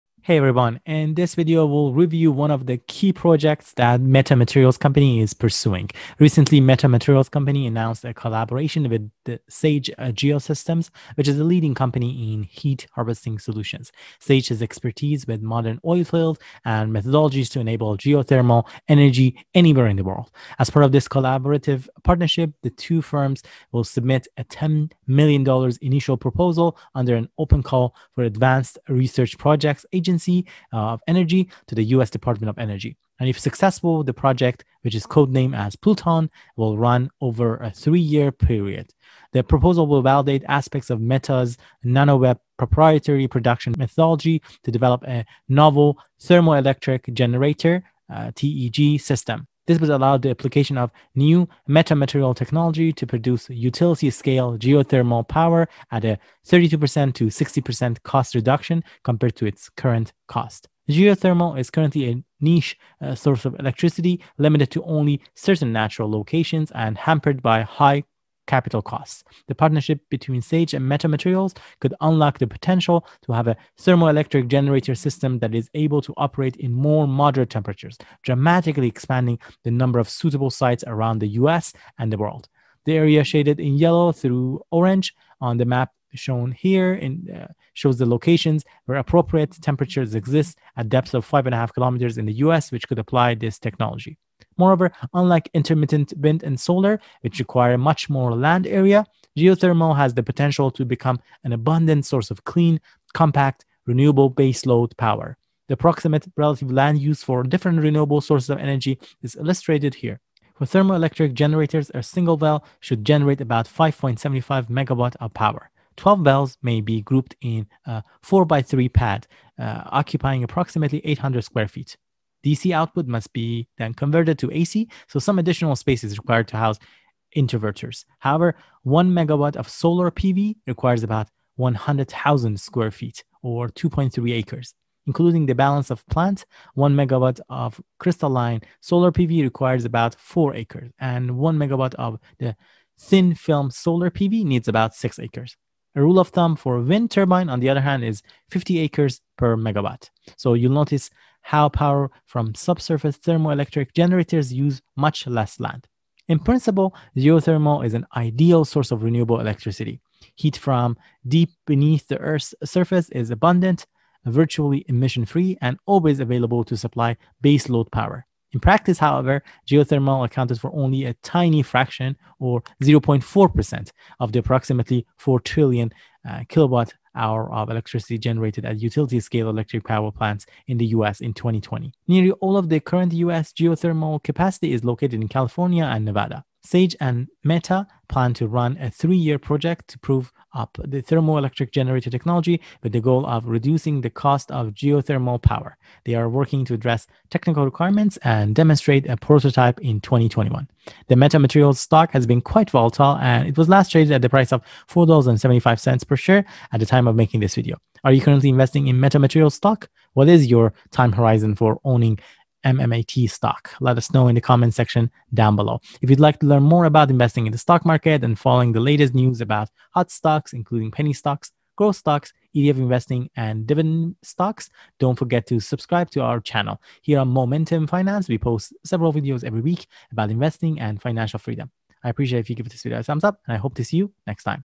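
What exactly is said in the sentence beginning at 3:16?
They are working to address technical requirements and demonstrate a prototype in 2021.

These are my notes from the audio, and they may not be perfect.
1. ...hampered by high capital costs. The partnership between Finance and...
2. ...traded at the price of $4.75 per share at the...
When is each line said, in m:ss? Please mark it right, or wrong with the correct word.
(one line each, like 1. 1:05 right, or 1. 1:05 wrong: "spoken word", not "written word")
1. 1:06 wrong: "Sage", not "Finance"
2. 3:23 right.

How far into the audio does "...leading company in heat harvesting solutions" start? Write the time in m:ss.
0:11.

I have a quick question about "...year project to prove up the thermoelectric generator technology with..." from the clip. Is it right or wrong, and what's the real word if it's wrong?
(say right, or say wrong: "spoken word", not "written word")
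right.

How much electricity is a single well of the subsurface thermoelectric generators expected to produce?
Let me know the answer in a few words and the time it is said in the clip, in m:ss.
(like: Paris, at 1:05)
5.75 megawatt, at 1:53.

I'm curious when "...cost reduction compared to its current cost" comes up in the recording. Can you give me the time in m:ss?
0:58.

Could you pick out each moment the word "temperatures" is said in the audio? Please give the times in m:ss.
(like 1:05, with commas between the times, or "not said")
1:17, 1:29.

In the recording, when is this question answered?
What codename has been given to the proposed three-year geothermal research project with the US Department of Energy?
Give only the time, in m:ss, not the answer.
0:35.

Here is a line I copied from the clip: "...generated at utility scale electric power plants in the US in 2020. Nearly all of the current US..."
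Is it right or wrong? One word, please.
right.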